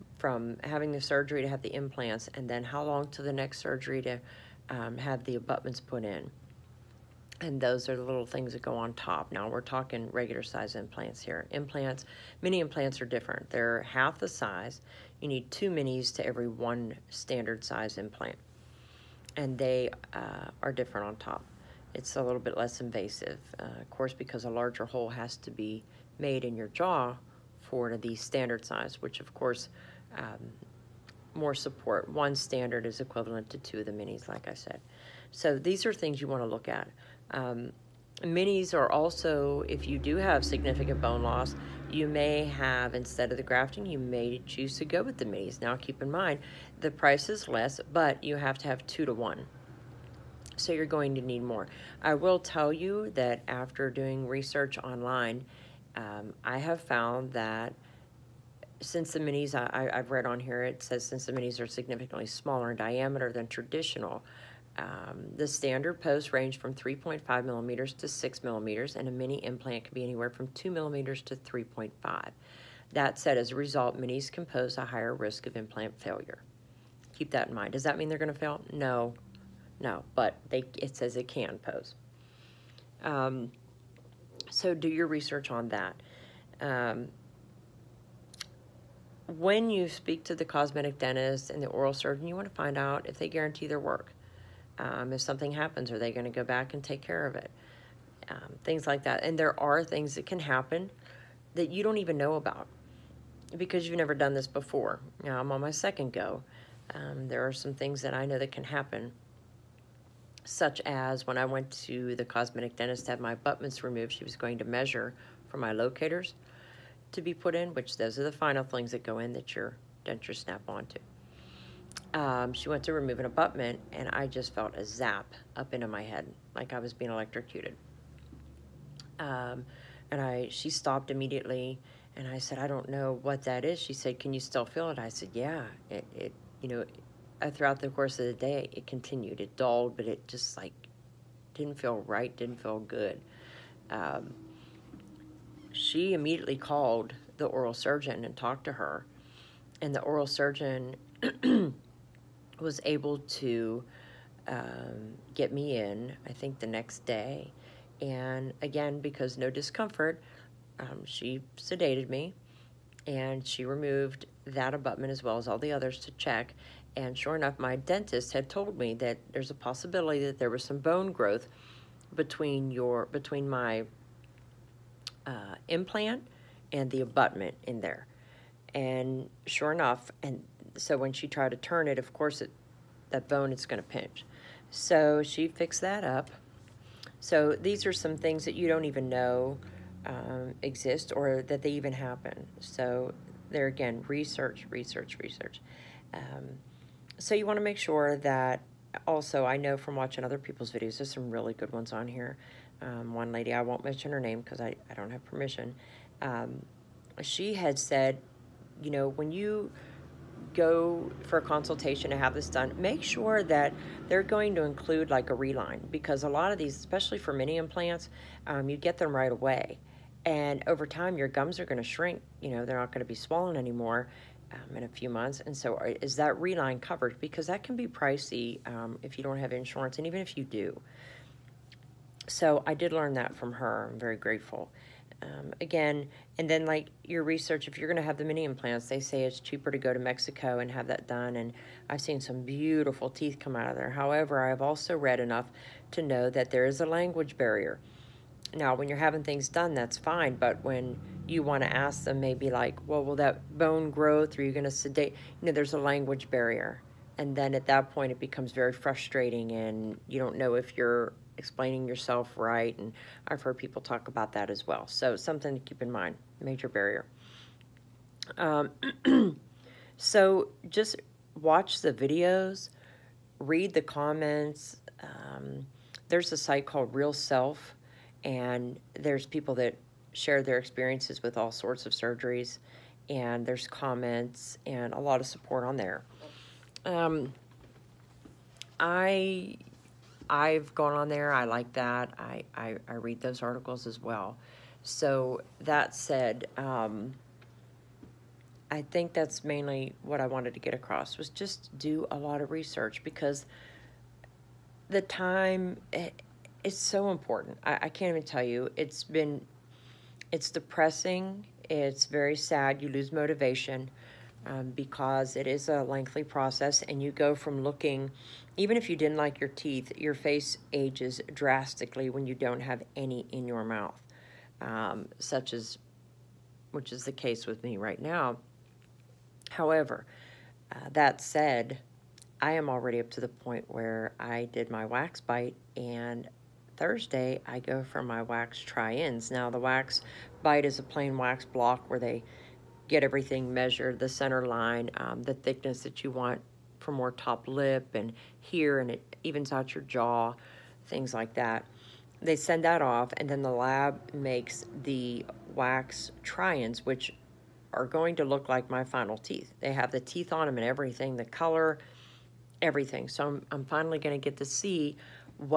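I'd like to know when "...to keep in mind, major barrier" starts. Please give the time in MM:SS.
04:25.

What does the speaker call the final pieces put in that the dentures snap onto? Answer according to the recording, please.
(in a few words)
Locators.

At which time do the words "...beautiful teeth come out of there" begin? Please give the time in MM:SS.
04:02.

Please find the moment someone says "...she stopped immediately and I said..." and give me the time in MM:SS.
02:10.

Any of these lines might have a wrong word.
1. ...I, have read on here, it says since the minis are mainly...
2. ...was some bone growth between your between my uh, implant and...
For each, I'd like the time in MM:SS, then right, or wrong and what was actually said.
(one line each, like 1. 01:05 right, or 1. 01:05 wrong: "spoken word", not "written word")
1. 00:59 wrong: "significantly", not "mainly"
2. 02:50 right.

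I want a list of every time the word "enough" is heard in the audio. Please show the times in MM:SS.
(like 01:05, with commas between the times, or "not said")
02:47, 02:59, 04:05.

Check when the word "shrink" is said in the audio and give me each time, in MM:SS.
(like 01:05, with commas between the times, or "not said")
03:41.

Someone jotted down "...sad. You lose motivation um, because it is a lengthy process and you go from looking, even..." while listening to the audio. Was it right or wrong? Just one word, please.
right.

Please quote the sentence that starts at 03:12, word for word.
So there again, research, research, research.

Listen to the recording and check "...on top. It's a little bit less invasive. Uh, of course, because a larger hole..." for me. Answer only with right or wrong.
right.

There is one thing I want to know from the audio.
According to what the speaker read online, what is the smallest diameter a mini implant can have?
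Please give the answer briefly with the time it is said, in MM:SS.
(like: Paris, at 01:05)
2 millimeters, at 01:10.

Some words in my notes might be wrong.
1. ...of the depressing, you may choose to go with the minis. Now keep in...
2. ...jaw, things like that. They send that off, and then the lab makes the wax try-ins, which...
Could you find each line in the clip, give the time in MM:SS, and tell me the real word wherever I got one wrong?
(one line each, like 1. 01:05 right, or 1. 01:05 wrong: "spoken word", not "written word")
1. 00:43 wrong: "grafting", not "depressing"
2. 05:49 right.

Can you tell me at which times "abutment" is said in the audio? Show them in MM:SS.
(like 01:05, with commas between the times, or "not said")
00:05, 01:53, 02:03, 02:44, 02:57.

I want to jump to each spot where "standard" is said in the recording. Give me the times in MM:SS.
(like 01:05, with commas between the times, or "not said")
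00:17, 00:28, 00:32, 01:05.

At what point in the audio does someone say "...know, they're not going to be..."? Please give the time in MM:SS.
03:42.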